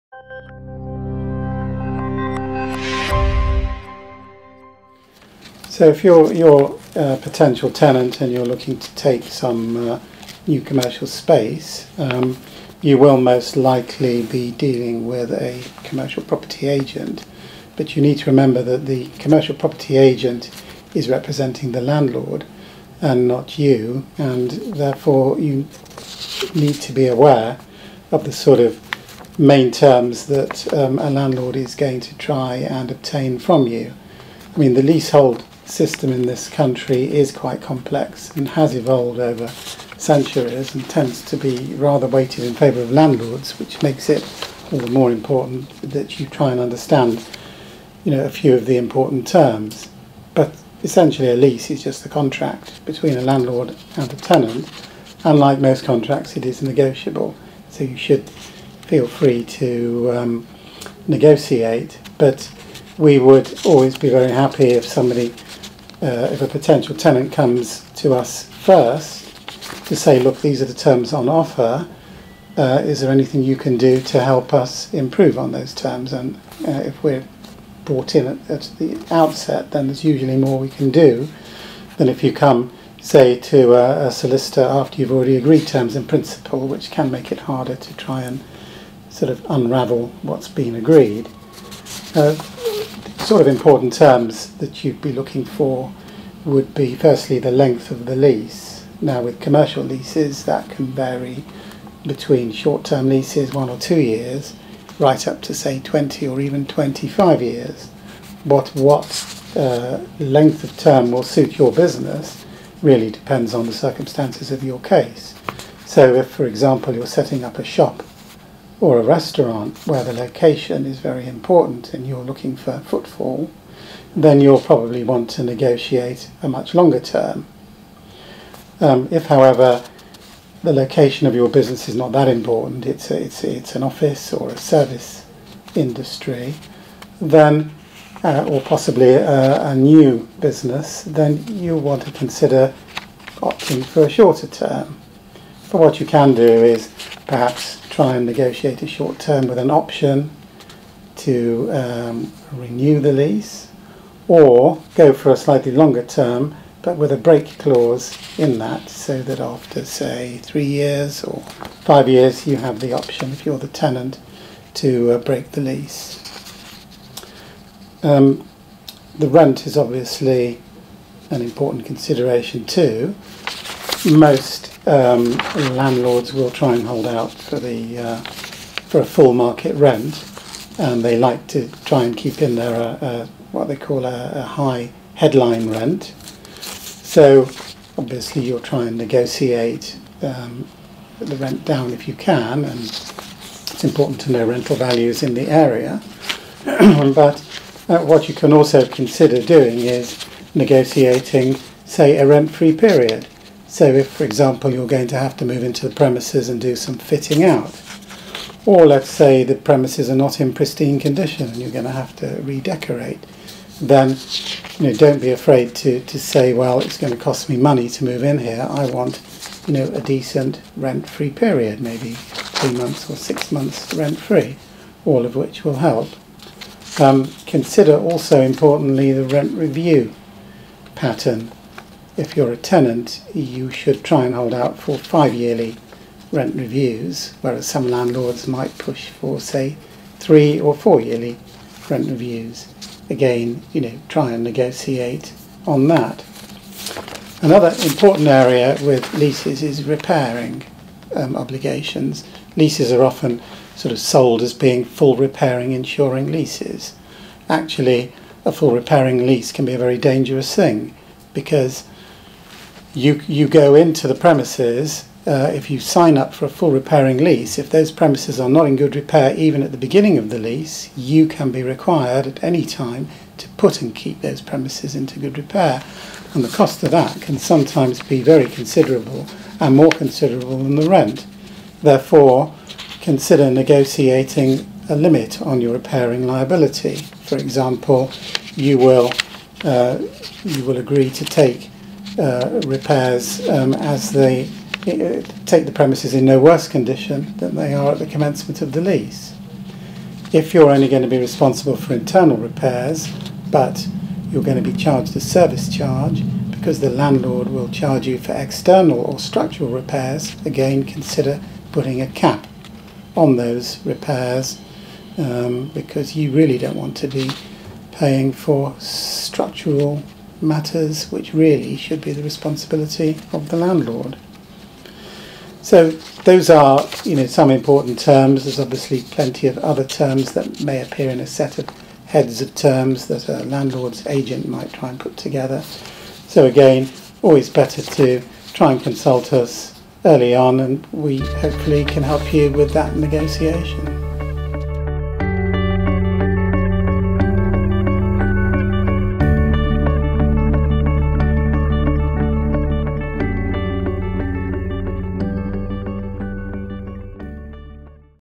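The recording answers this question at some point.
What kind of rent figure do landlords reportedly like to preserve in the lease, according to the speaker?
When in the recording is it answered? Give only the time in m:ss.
3:04.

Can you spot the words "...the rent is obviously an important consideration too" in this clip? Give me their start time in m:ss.
2:49.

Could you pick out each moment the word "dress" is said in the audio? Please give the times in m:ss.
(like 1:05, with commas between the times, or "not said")
not said.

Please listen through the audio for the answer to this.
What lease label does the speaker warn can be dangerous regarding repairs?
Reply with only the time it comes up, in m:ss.
4:14.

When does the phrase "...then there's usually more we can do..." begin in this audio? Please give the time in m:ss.
1:19.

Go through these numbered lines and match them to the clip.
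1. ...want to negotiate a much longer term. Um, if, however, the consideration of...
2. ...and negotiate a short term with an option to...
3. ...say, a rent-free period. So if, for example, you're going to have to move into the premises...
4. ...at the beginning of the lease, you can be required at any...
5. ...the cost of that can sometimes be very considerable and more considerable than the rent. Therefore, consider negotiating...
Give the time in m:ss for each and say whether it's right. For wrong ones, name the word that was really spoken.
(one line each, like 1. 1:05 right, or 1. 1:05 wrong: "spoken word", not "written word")
1. 2:05 wrong: "location", not "consideration"
2. 2:28 right
3. 3:21 right
4. 4:29 right
5. 4:36 right.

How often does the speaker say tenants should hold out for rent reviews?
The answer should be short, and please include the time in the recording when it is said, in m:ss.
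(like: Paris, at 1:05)
5 yearly, at 3:54.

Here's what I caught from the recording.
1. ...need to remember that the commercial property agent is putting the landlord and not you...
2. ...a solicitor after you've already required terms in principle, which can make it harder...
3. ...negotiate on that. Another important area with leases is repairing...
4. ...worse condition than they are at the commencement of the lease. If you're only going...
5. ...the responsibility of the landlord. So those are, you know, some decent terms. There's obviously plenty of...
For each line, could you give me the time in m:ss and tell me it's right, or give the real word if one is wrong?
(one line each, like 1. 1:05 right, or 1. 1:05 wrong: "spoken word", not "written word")
1. 0:18 wrong: "representing", not "putting"
2. 1:24 wrong: "agreed", not "required"
3. 4:04 right
4. 4:56 right
5. 5:22 wrong: "important", not "decent".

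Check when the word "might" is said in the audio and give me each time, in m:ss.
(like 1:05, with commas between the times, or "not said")
3:58, 5:34.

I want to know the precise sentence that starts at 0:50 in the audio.
But essentially, a lease is just a contract between a landlord and a tenant, Unlike most contracts, it is negotiable.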